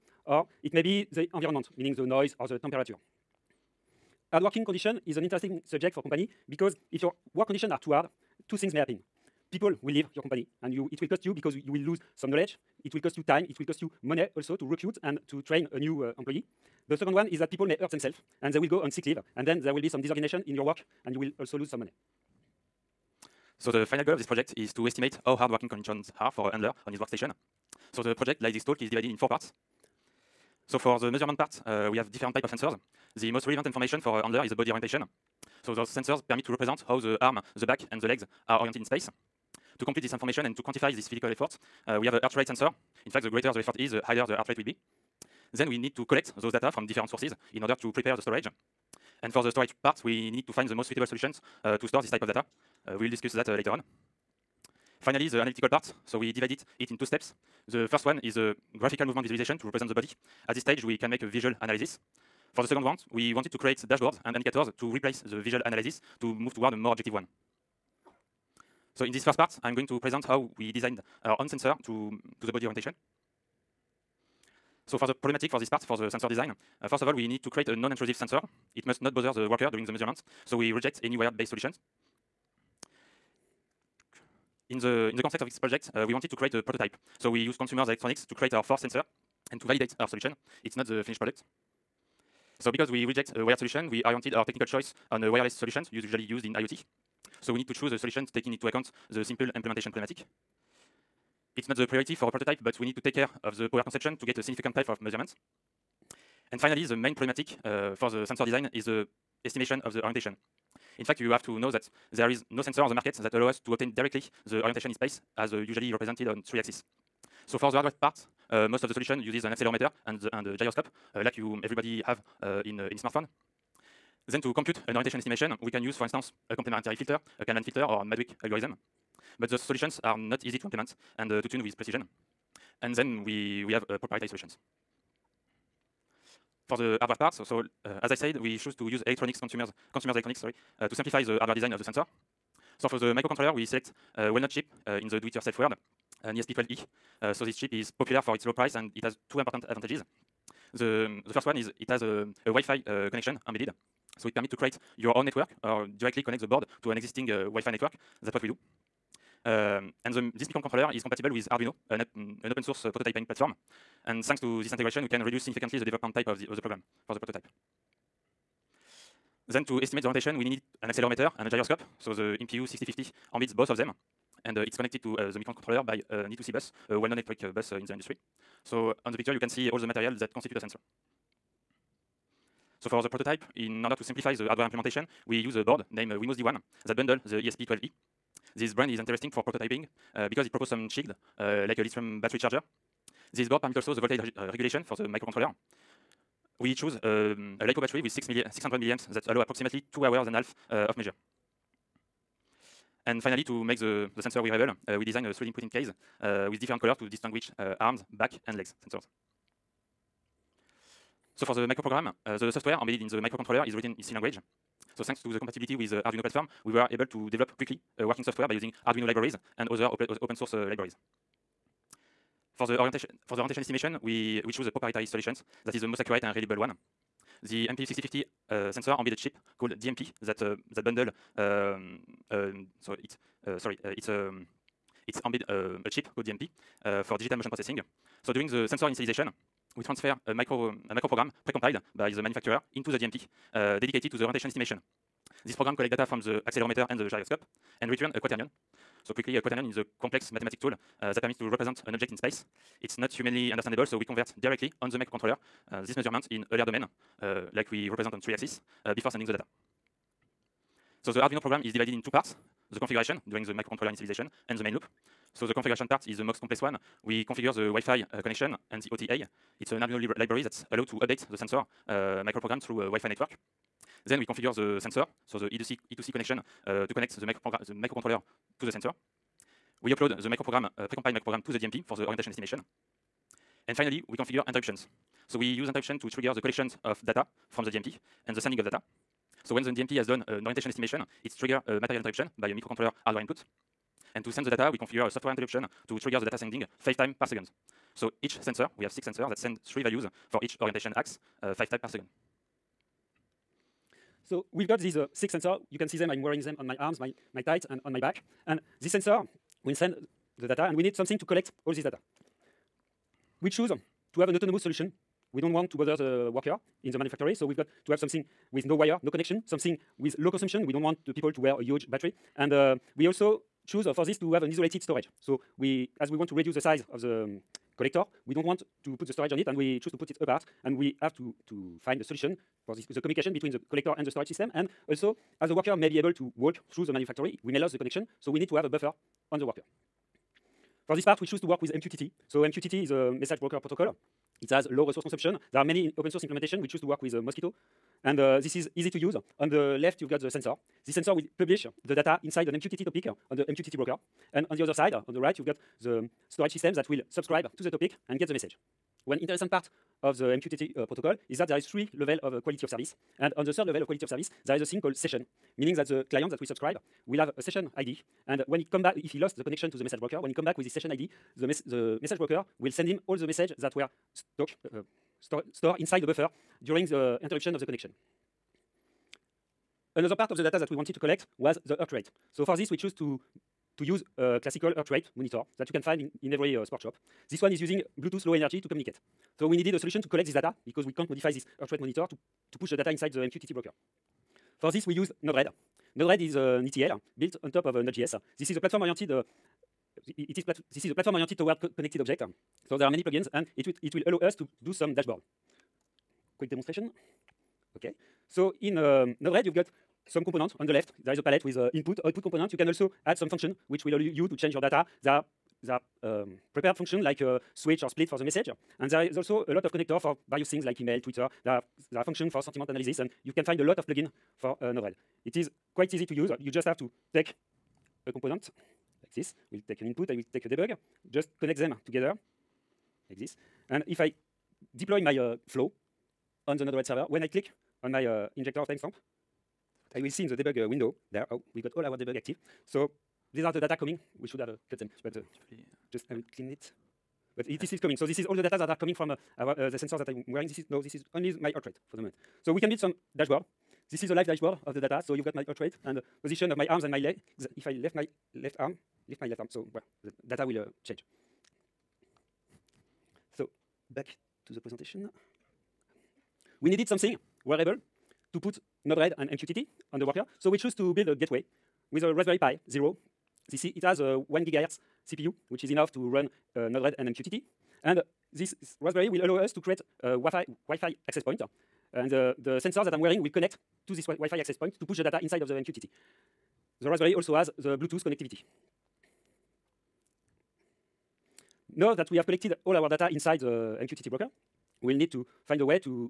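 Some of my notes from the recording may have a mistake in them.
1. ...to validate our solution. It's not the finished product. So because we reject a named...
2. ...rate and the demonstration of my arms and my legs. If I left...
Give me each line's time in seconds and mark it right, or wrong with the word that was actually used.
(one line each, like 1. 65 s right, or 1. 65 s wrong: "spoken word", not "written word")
1. 89 s wrong: "wired", not "named"
2. 455 s wrong: "position", not "demonstration".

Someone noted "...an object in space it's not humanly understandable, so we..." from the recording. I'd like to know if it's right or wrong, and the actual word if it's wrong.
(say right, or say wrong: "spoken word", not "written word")
right.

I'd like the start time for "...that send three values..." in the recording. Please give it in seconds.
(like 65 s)
299 s.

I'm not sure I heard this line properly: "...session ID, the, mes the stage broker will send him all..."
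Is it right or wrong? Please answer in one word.
wrong.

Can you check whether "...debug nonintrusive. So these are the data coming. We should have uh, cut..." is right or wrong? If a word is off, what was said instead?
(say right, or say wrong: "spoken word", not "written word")
wrong: "active", not "nonintrusive".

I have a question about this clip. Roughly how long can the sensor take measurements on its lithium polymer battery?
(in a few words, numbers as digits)
2.5 hours.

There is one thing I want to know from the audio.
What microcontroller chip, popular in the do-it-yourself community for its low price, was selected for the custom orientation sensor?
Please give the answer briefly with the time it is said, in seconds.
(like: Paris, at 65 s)
ESP12E, at 146 s.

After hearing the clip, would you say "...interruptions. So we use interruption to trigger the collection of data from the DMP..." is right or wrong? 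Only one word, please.
right.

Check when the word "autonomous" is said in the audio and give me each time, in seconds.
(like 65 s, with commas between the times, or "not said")
314 s.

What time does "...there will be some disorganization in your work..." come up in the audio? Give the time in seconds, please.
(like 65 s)
19 s.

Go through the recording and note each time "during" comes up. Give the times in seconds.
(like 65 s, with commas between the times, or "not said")
79 s, 238 s, 263 s, 376 s.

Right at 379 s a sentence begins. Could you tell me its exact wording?
Another part of the data that we wanted to collect was the heart rate.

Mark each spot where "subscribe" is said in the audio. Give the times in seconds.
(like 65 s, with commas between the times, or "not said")
357 s, 366 s.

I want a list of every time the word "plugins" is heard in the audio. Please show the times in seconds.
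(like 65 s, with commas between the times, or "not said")
403 s, 423 s.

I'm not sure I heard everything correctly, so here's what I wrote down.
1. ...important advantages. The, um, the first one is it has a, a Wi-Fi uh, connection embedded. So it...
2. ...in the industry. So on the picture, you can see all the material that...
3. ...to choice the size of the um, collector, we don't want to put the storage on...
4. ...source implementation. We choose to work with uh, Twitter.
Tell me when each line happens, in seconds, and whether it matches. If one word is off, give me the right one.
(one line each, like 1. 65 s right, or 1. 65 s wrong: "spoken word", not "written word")
1. 149 s right
2. 177 s right
3. 326 s wrong: "reduce", not "choice"
4. 346 s wrong: "Mosquitto", not "Twitter".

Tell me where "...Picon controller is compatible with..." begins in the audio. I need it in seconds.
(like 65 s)
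160 s.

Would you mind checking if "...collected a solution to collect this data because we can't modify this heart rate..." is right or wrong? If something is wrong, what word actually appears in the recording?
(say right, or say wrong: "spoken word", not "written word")
wrong: "needed", not "collected".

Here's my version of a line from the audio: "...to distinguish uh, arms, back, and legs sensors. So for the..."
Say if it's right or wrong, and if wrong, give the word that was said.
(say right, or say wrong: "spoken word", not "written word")
right.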